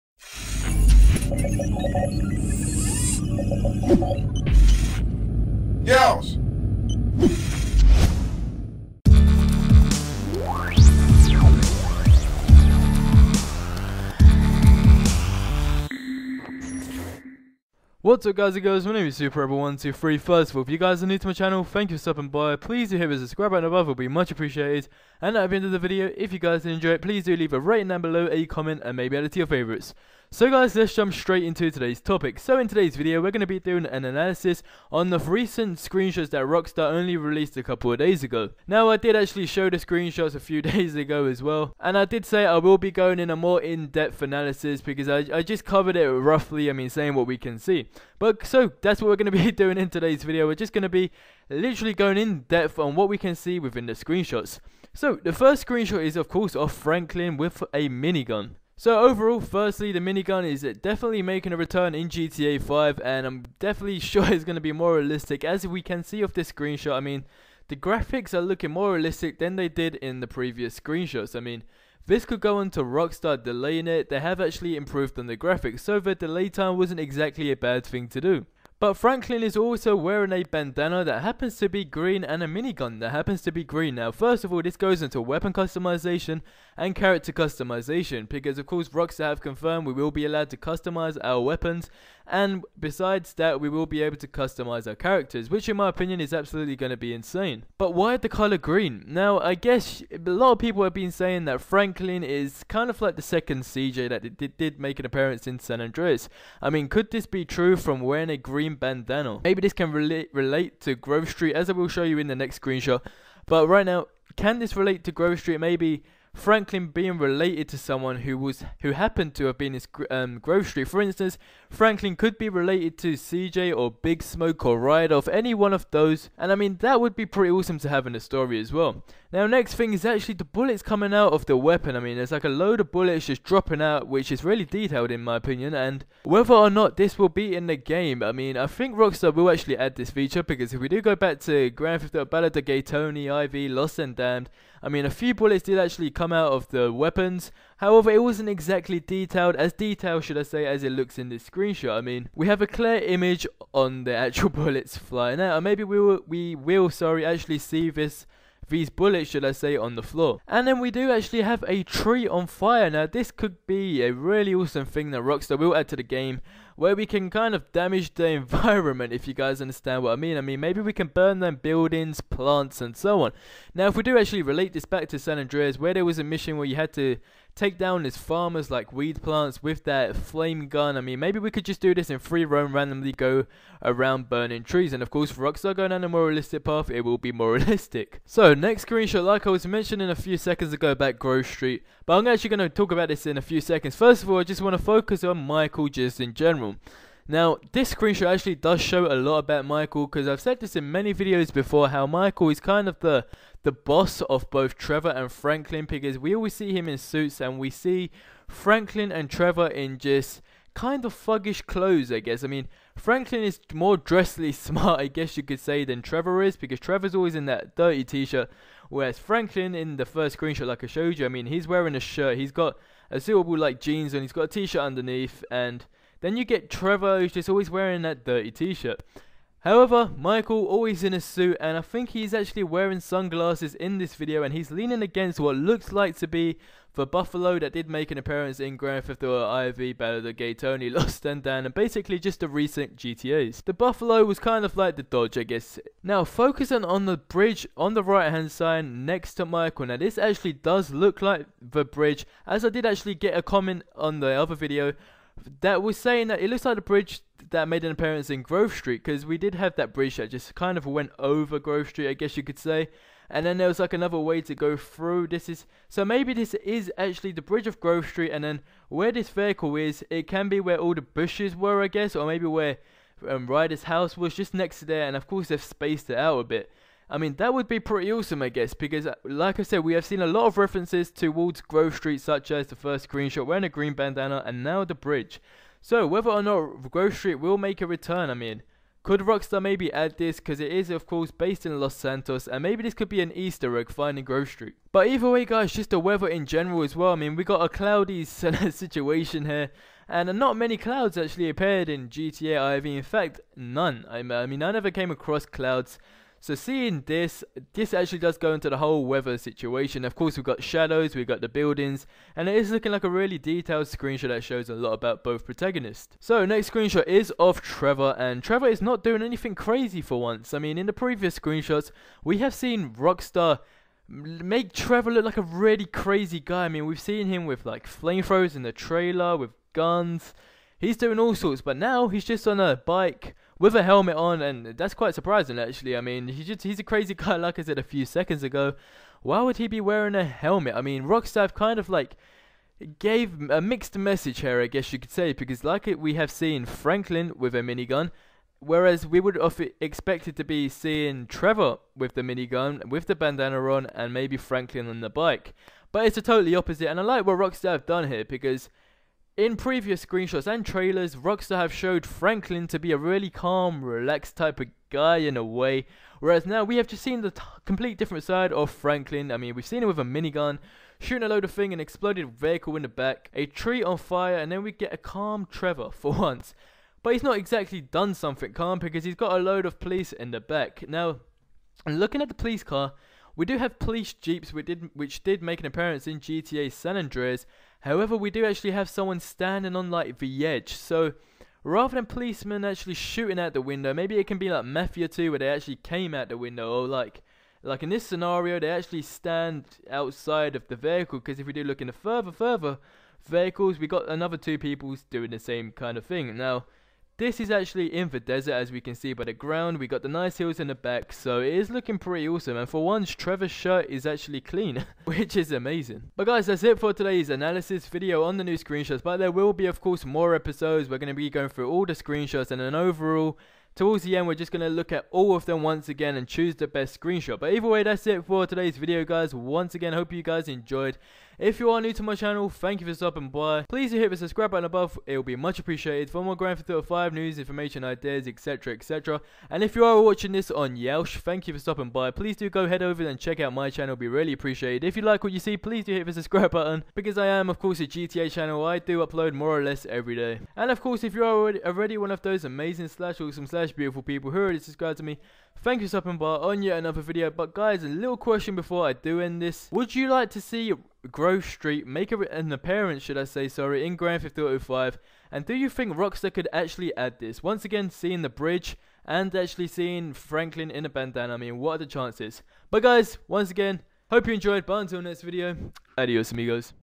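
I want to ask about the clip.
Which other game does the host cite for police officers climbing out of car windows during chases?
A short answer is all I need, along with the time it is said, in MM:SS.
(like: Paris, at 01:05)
Mafia 2, at 06:34.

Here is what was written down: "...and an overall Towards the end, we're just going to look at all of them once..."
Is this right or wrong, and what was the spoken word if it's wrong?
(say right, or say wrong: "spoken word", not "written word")
right.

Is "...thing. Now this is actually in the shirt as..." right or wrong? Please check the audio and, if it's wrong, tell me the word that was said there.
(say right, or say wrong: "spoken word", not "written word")
wrong: "desert", not "shirt".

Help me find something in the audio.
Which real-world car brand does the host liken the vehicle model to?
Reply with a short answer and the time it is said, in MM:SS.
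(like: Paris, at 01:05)
Dodge, at 04:05.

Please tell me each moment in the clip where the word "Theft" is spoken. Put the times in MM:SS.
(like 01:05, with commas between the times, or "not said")
02:22, 03:59, 07:16, 07:44.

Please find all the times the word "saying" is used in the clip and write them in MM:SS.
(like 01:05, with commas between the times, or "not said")
00:46, 01:41, 04:15.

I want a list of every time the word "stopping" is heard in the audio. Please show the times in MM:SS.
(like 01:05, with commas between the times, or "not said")
00:22, 07:12, 07:21, 07:35.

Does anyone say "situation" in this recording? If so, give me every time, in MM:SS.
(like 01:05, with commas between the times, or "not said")
04:58, 05:09.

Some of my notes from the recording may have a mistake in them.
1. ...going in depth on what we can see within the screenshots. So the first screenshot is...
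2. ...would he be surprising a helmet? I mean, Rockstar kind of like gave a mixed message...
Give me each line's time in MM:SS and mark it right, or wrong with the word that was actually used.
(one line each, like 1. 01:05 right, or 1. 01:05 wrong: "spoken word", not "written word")
1. 00:51 right
2. 05:39 wrong: "wearing", not "surprising".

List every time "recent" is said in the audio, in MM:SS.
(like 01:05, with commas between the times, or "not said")
00:35, 04:02.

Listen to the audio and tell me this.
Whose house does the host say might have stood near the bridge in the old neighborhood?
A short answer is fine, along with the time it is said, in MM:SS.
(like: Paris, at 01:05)
Ryder's house, at 04:33.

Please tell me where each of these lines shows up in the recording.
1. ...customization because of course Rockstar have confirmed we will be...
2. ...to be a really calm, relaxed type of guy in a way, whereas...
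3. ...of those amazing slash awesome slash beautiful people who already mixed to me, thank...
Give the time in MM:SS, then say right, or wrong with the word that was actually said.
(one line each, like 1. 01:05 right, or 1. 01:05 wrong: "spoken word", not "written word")
1. 01:27 right
2. 06:02 right
3. 07:32 wrong: "subscribed", not "mixed".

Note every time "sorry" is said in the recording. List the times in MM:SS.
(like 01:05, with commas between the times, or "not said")
02:36, 07:43.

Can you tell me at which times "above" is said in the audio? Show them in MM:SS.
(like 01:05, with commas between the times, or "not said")
00:23, 07:14.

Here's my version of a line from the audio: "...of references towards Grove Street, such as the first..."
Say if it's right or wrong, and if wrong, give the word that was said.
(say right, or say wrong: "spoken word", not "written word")
right.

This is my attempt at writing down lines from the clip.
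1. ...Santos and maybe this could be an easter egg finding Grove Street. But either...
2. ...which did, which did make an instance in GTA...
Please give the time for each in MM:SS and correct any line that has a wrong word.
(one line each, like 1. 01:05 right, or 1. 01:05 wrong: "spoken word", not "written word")
1. 04:51 right
2. 06:24 wrong: "appearance", not "instance".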